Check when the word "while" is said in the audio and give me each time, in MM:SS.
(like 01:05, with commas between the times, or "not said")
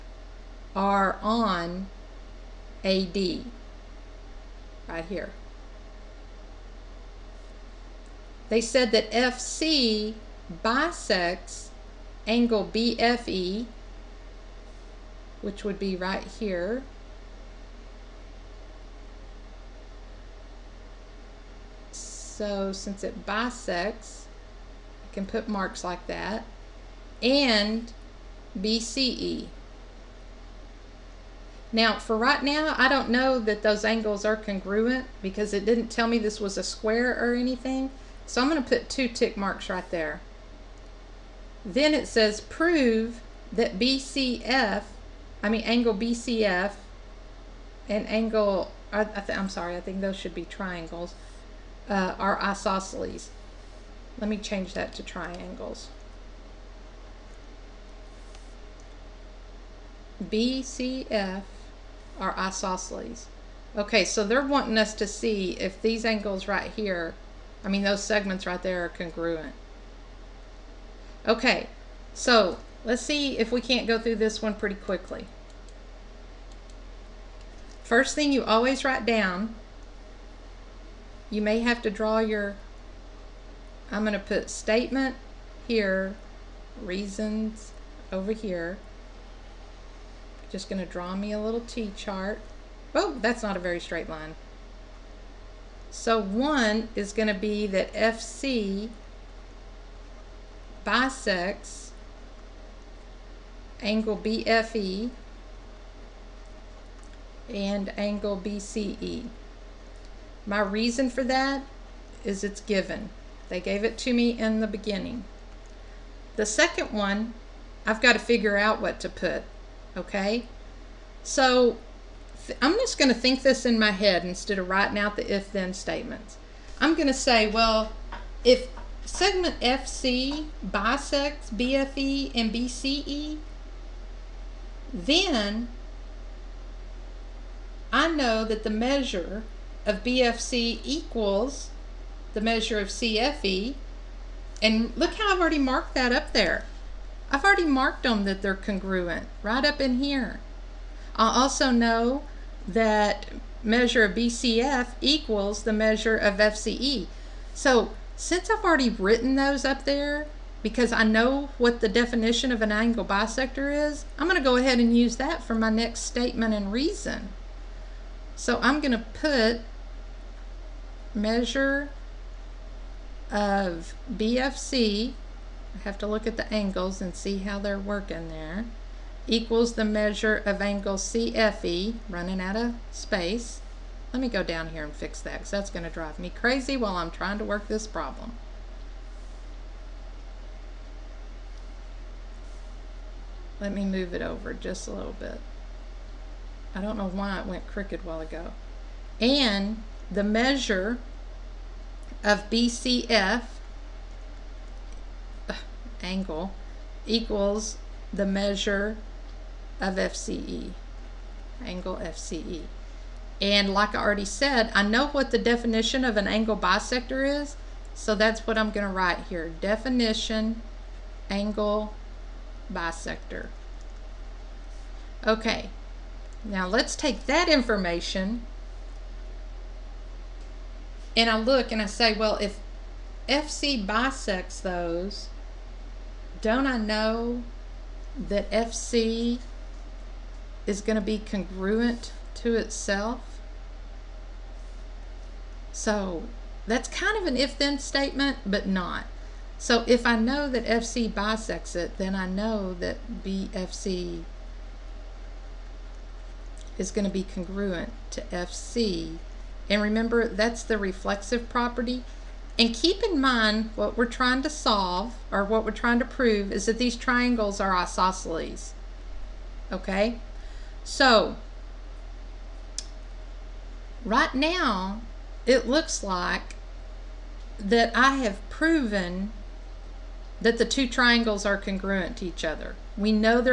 03:06, 03:18.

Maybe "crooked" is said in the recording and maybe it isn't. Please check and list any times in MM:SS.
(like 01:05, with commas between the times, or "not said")
03:17.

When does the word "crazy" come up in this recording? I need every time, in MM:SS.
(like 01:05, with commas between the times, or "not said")
03:06.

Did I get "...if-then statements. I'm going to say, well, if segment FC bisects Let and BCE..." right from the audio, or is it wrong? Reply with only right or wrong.
wrong.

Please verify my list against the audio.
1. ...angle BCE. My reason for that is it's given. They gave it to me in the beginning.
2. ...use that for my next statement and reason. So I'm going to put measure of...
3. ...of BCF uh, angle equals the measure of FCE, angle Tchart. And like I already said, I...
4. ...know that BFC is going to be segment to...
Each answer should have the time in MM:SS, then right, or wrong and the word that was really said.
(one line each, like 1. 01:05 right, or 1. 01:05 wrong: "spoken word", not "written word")
1. 01:47 right
2. 02:44 right
3. 03:22 wrong: "FCE", not "Tchart"
4. 04:12 wrong: "congruent", not "segment".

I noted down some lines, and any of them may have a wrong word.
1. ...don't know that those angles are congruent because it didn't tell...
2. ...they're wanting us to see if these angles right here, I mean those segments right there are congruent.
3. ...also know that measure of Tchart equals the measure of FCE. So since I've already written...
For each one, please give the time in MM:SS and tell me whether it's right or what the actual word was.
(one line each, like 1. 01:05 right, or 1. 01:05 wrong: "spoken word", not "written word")
1. 00:32 right
2. 01:04 right
3. 02:31 wrong: "BCF", not "Tchart".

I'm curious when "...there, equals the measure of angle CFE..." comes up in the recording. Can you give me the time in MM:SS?
02:58.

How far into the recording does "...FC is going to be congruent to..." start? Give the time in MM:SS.
03:58.